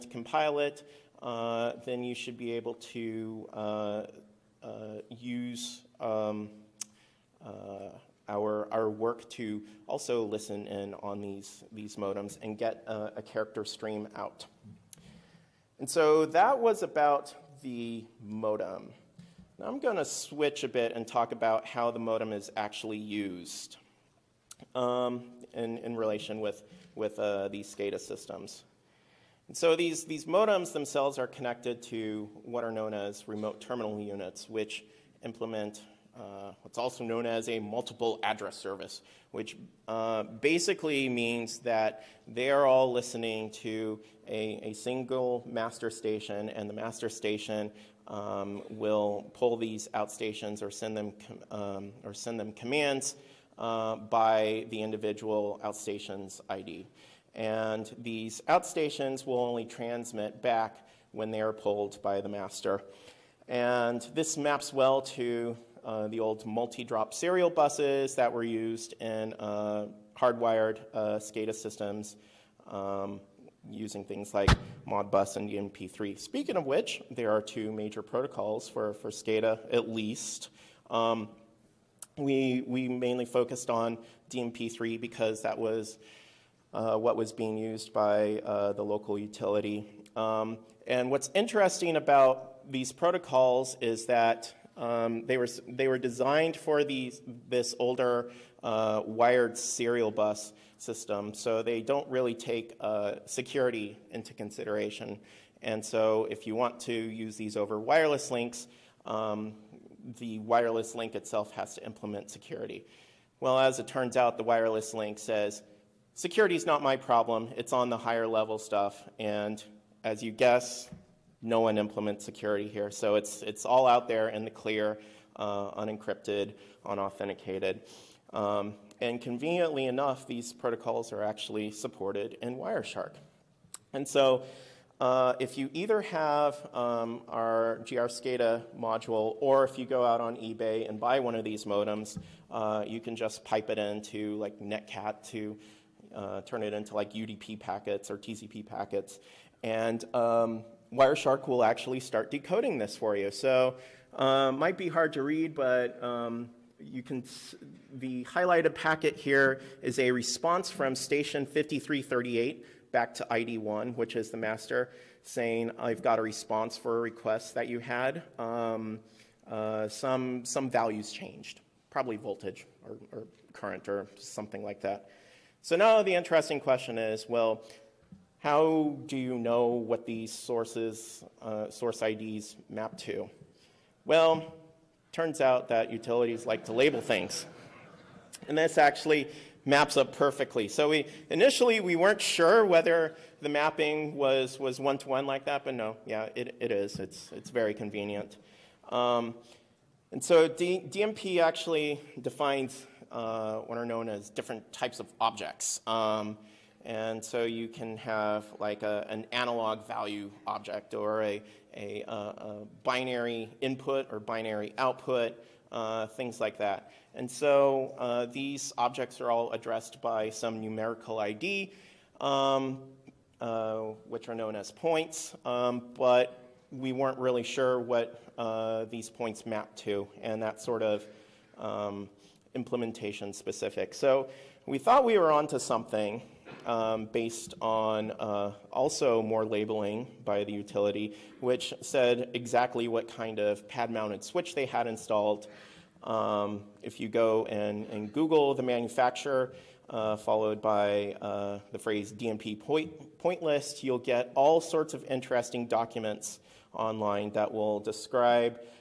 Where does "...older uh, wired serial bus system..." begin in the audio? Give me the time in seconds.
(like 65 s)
97 s.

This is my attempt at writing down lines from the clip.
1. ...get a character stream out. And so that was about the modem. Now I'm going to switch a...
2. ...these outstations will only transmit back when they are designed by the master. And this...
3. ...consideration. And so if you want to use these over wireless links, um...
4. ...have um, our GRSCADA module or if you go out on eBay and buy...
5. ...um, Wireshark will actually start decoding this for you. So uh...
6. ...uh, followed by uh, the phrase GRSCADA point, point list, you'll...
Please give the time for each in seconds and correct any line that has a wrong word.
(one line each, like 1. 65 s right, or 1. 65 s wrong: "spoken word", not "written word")
1. 12 s right
2. 57 s wrong: "pulled", not "designed"
3. 104 s right
4. 135 s right
5. 150 s right
6. 249 s wrong: "DNP", not "GRSCADA".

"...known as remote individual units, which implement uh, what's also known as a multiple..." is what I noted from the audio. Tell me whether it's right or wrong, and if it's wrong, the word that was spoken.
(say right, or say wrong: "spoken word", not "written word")
wrong: "terminal", not "individual".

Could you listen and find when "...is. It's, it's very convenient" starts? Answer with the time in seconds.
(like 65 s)
196 s.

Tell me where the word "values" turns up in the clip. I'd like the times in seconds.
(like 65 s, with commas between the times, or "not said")
170 s, 209 s.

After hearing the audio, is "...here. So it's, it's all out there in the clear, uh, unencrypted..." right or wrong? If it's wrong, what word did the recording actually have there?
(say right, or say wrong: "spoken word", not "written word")
right.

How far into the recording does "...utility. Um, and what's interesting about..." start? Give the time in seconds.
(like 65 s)
89 s.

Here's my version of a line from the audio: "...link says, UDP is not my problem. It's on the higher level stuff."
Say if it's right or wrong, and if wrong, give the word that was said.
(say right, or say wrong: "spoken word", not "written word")
wrong: "Security", not "UDP".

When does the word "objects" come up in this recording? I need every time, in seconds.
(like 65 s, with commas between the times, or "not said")
205 s, 210 s, 218 s.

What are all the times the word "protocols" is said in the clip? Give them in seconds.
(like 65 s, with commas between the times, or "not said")
78 s, 92 s, 130 s.